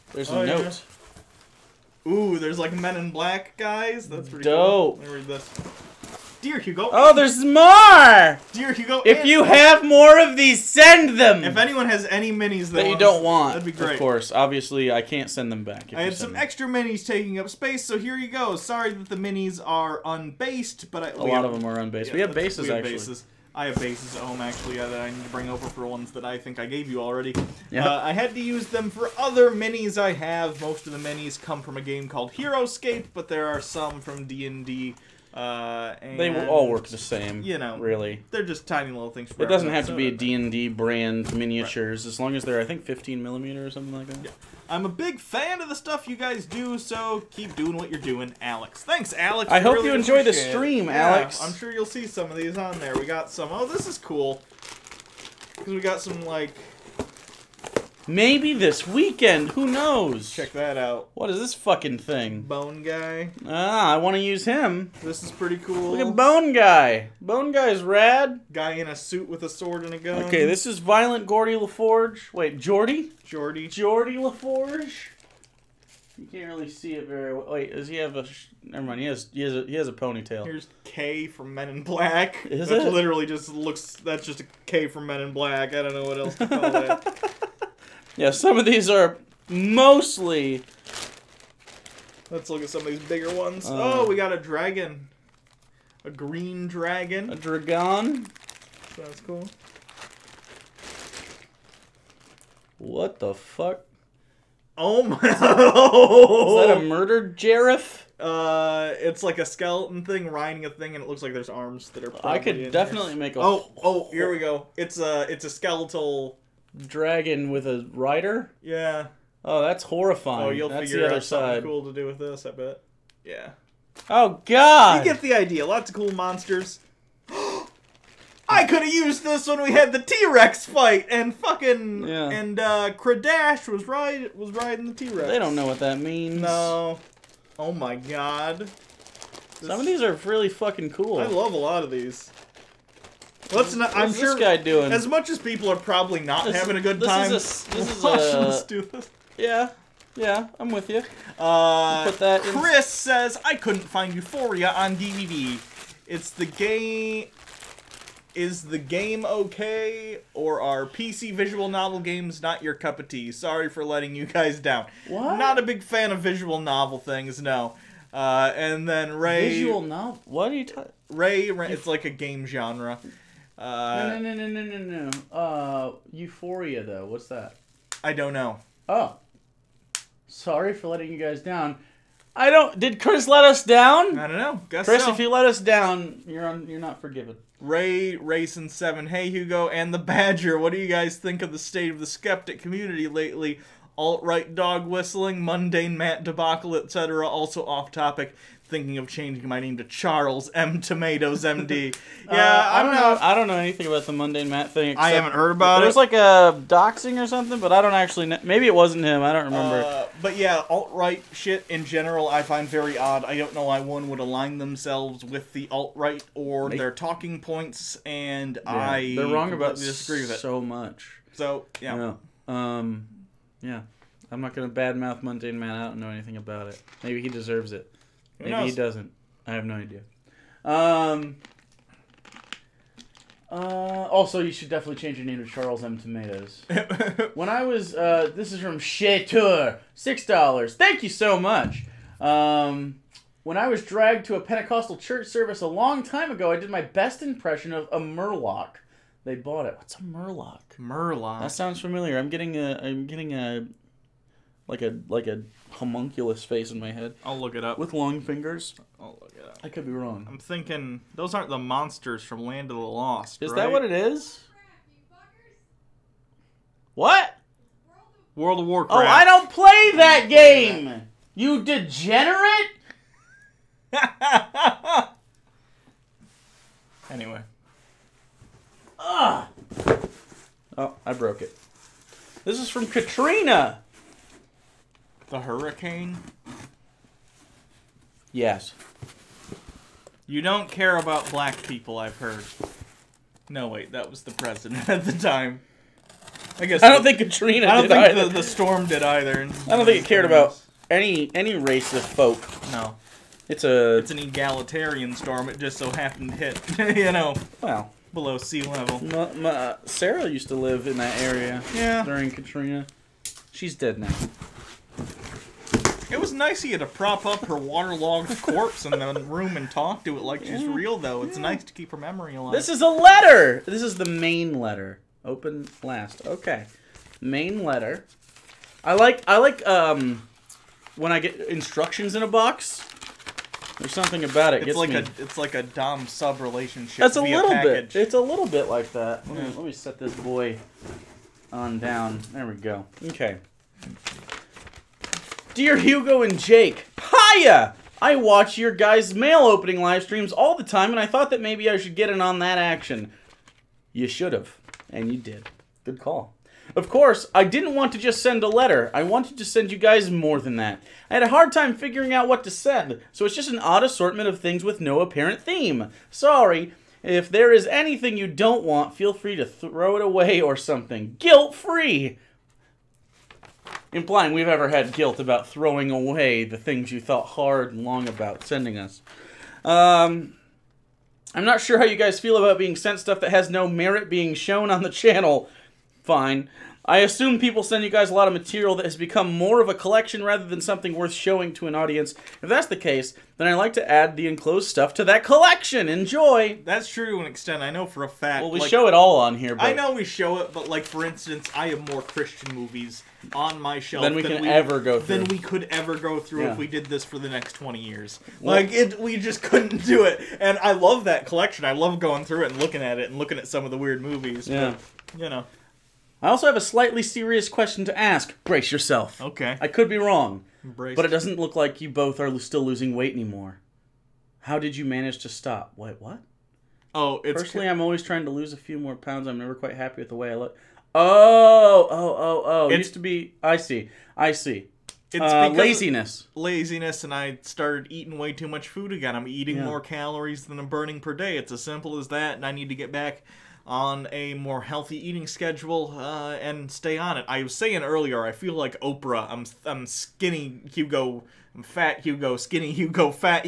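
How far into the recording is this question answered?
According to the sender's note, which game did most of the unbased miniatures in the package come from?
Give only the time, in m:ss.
0:32.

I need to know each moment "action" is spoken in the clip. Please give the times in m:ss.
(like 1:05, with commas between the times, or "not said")
5:52.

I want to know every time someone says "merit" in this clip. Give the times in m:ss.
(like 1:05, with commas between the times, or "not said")
6:23.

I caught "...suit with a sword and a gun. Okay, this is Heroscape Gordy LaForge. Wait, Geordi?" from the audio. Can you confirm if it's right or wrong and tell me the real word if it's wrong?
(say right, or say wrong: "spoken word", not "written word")
wrong: "Violent", not "Heroscape".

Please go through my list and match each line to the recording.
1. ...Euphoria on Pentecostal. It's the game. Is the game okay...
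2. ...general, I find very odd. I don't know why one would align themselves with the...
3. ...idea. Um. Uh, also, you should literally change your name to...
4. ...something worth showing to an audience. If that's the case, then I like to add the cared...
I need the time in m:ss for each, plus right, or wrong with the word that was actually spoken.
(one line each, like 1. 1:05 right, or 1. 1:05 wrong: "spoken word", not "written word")
1. 2:34 wrong: "DVD", not "Pentecostal"
2. 3:31 right
3. 3:49 wrong: "definitely", not "literally"
4. 6:30 wrong: "enclosed", not "cared".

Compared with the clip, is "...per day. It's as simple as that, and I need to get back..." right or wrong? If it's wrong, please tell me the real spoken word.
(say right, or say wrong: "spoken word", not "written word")
right.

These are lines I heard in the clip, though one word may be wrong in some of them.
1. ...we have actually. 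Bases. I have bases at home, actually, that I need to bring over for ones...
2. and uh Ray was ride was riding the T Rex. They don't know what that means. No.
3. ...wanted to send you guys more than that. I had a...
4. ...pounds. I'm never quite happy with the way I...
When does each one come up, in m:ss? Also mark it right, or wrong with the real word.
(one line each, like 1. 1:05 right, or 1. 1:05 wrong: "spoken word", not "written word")
1. 0:22 right
2. 2:12 wrong: "Kradash", not "Ray"
3. 5:59 right
4. 7:08 right.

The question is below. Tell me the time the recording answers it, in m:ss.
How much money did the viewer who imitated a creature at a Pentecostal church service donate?
3:59.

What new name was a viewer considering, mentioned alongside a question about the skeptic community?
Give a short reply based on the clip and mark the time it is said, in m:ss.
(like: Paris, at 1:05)
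Charles M. Tomatoes MD, at 3:19.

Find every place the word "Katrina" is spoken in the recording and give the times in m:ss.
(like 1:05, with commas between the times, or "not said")
4:42, 4:57, 5:12.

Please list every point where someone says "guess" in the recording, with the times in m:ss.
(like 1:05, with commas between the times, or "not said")
3:04, 4:56.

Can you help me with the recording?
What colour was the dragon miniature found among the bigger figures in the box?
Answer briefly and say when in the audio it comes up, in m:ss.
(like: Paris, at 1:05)
Green, at 1:36.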